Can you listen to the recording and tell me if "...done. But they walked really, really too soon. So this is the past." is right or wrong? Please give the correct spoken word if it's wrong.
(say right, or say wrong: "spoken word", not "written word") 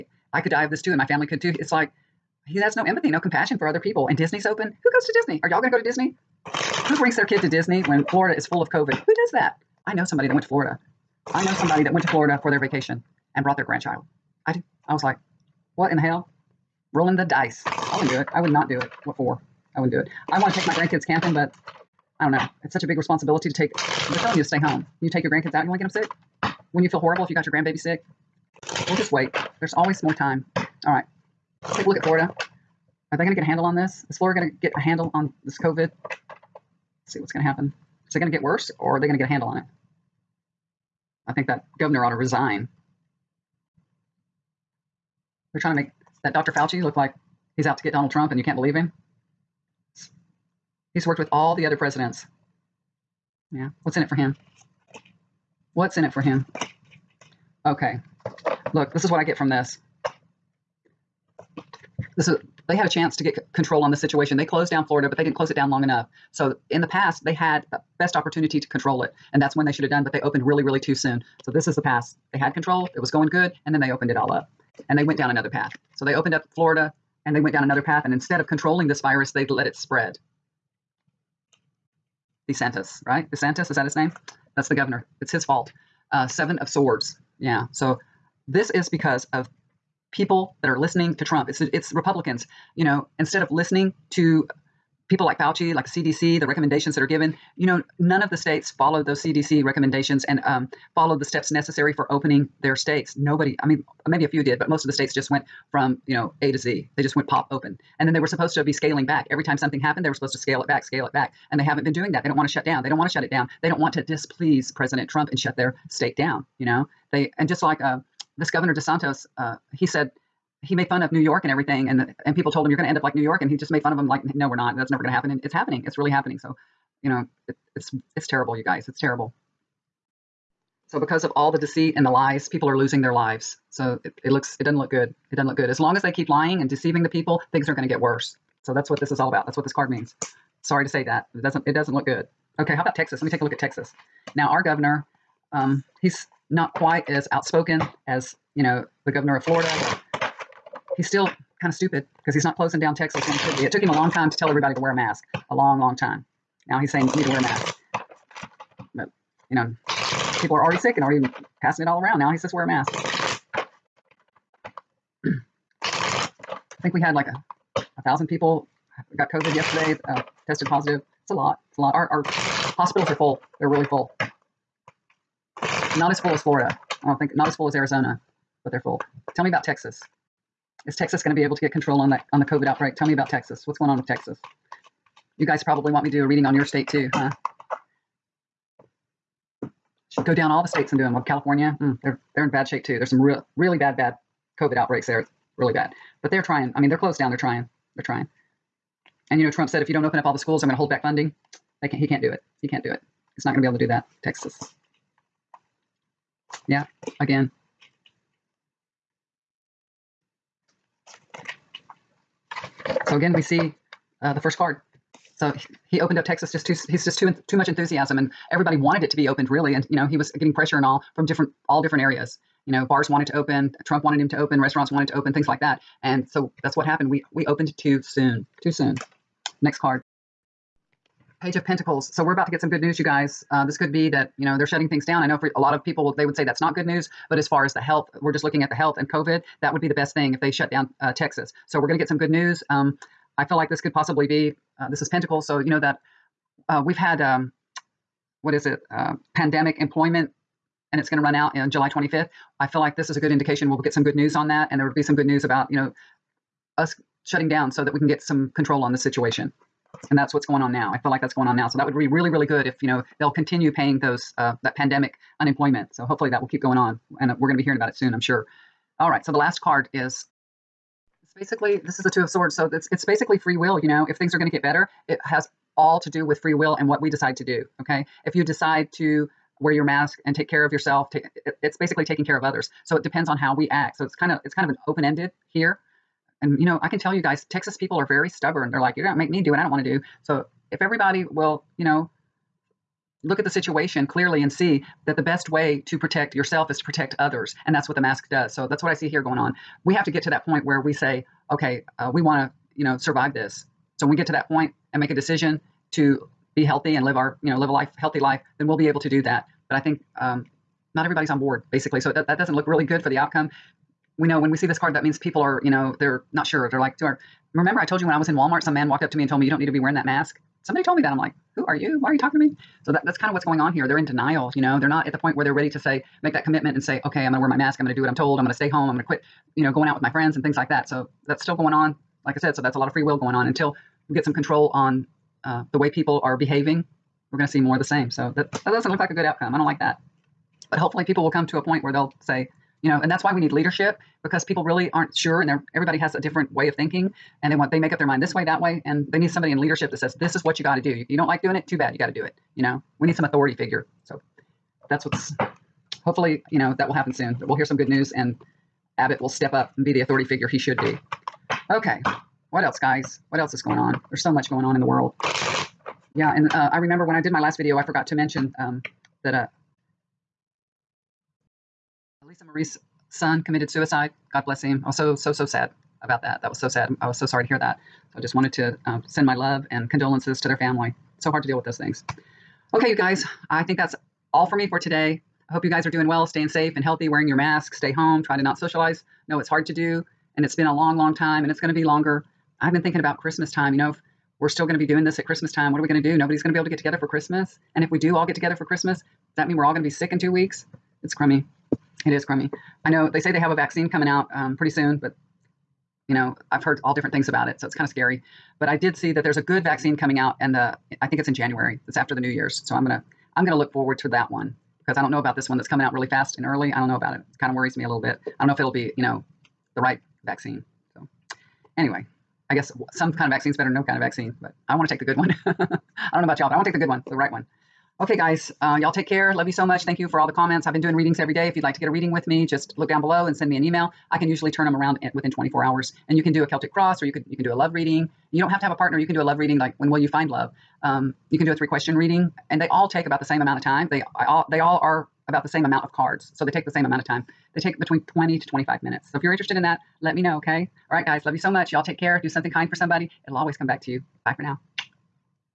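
wrong: "opened", not "walked".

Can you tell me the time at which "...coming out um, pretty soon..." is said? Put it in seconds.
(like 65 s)
403 s.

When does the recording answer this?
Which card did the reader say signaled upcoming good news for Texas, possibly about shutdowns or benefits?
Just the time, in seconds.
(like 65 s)
231 s.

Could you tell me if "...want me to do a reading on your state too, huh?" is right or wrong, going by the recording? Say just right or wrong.
right.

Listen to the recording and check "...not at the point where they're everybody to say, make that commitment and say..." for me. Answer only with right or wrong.
wrong.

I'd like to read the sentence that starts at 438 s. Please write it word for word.
You don't have to have a partner.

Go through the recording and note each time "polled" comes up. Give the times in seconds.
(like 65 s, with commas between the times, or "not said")
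not said.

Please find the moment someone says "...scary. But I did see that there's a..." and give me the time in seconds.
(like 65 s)
407 s.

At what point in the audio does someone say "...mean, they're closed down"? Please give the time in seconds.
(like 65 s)
196 s.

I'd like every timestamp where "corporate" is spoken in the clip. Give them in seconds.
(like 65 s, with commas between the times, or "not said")
not said.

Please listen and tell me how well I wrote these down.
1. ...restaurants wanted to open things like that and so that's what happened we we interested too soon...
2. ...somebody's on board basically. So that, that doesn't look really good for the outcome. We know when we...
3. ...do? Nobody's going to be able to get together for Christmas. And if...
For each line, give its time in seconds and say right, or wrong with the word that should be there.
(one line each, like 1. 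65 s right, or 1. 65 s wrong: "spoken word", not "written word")
1. 224 s wrong: "opened", not "interested"
2. 311 s wrong: "everybody", not "somebody"
3. 396 s right.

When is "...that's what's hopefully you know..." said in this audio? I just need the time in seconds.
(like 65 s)
354 s.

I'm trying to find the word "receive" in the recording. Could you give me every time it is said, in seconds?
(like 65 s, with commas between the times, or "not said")
not said.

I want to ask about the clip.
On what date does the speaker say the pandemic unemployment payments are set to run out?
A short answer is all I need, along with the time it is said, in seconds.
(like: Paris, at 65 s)
July 25th, at 251 s.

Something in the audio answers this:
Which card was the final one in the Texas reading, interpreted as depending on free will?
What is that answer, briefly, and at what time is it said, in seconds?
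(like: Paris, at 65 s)
Two of Swords, at 272 s.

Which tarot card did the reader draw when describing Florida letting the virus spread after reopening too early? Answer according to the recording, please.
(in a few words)
Seven of Swords.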